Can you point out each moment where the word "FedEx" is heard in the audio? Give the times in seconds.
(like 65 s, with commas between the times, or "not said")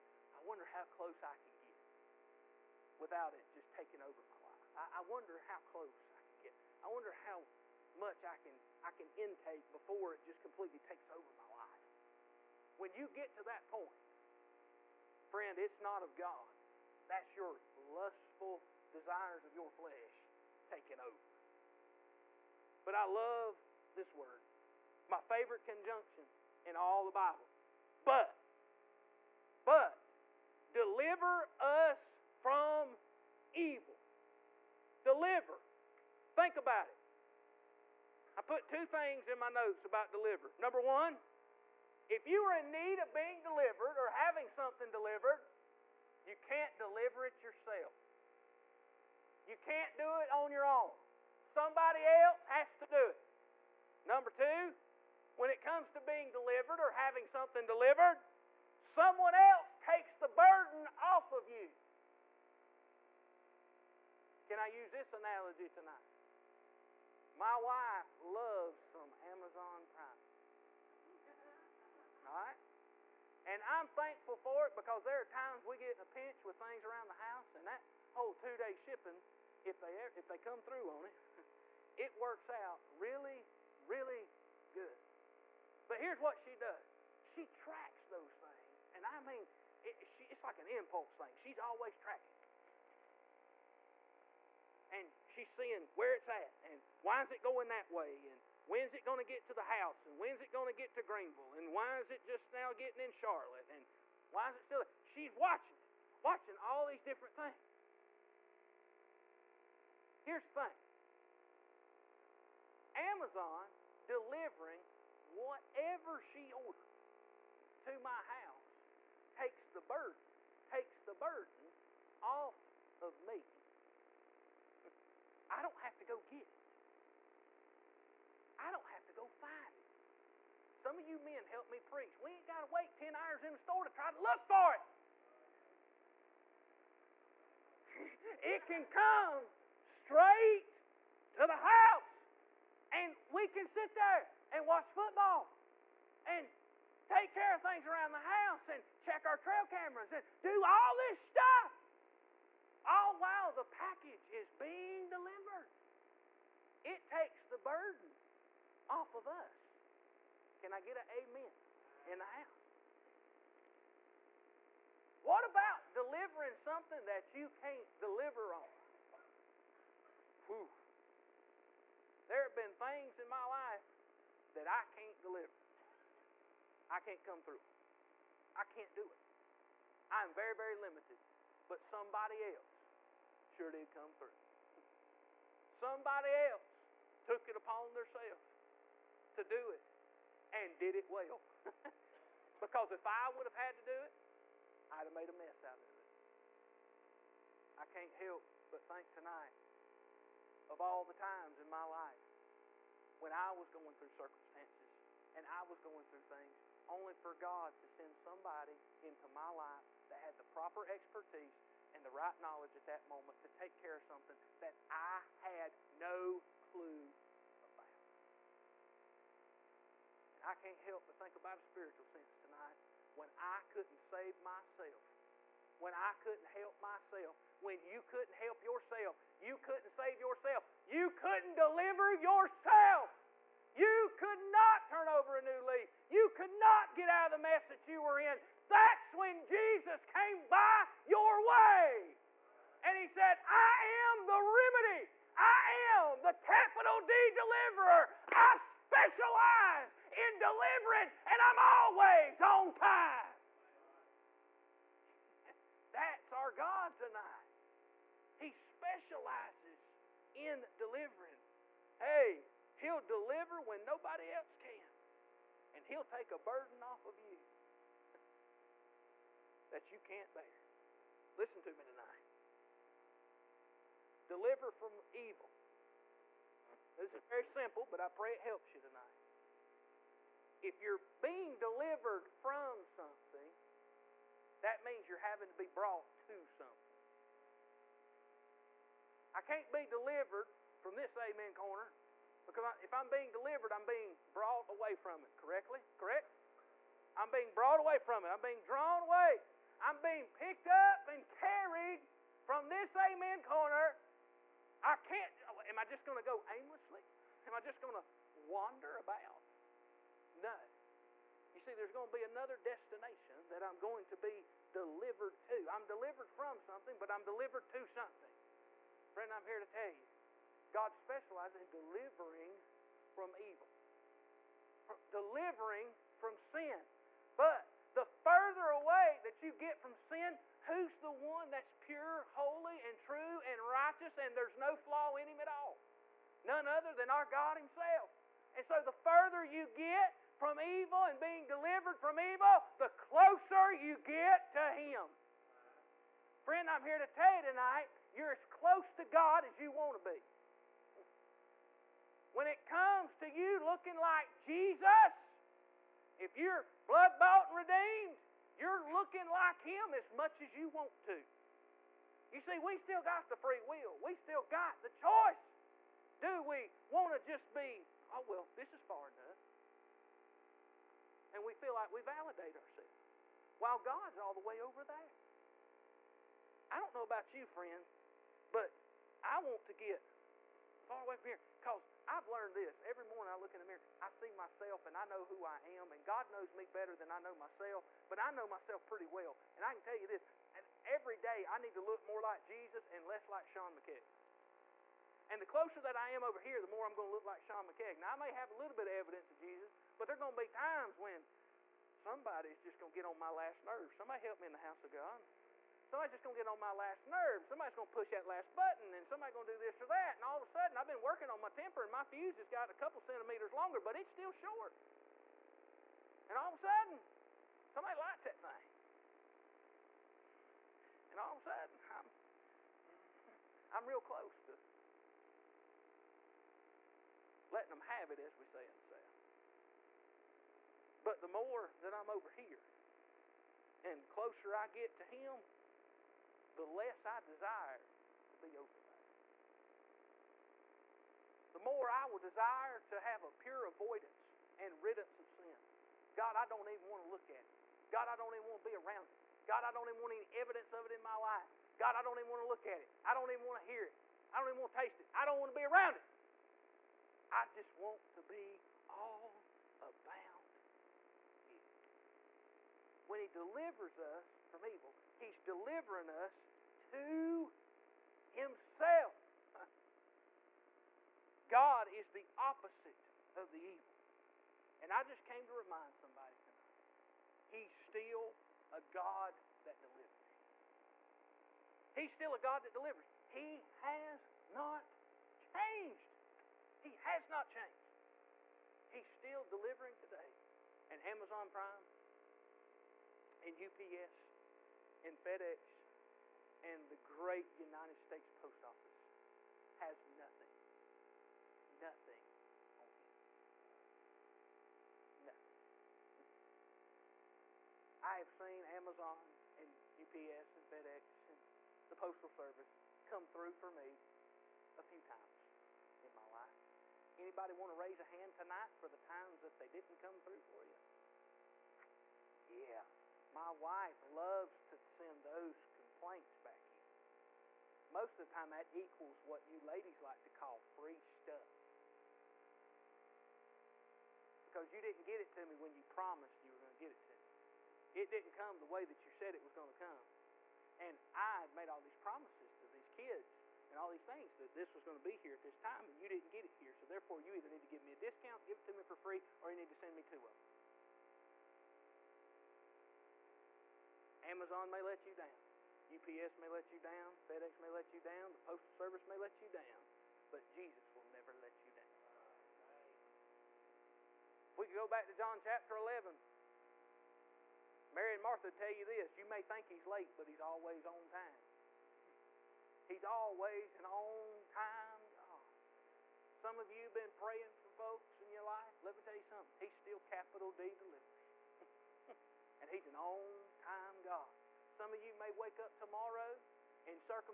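495 s, 510 s, 557 s.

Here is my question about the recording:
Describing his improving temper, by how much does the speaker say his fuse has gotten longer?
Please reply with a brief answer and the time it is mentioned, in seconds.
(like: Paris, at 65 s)
a couple centimeters, at 412 s.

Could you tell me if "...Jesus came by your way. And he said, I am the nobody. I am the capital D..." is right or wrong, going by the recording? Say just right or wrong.
wrong.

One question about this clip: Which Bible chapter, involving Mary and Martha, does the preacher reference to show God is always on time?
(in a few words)
John chapter 11.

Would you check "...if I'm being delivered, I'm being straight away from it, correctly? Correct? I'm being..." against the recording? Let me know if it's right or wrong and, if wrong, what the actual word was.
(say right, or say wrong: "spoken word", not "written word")
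wrong: "brought", not "straight".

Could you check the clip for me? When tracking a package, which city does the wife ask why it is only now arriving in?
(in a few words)
Charlotte.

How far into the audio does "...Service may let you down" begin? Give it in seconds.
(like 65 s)
558 s.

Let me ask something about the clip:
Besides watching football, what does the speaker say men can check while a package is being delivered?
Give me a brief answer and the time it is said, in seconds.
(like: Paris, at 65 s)
trail cameras, at 149 s.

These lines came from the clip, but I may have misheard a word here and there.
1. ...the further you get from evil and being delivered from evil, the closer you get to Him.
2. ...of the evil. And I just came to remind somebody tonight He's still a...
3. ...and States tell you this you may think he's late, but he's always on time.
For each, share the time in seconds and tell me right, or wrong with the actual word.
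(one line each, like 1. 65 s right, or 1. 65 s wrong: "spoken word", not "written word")
1. 338 s right
2. 473 s right
3. 568 s wrong: "Martha", not "States".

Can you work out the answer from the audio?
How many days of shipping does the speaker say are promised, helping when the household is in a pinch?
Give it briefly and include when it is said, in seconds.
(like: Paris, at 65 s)
2, at 78 s.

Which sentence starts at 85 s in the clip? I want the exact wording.
But here's what she does she tracks those things.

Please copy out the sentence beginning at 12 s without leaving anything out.
When you get to that point, friend, it's not of God.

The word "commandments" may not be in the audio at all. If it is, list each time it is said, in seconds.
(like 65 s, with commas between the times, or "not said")
not said.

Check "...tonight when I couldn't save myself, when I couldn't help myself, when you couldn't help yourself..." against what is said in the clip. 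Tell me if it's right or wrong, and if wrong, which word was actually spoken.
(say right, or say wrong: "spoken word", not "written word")
right.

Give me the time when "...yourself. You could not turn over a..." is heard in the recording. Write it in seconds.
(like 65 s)
232 s.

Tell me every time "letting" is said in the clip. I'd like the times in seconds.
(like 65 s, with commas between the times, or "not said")
427 s.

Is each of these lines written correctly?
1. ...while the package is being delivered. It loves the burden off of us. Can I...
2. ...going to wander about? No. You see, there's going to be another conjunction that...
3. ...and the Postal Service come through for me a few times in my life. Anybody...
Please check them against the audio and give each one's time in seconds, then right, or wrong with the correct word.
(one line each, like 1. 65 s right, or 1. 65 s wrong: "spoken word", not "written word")
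1. 153 s wrong: "takes", not "loves"
2. 307 s wrong: "destination", not "conjunction"
3. 511 s right.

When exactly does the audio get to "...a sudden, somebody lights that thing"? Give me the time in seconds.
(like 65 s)
416 s.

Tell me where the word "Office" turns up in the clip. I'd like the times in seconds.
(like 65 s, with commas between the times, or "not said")
498 s.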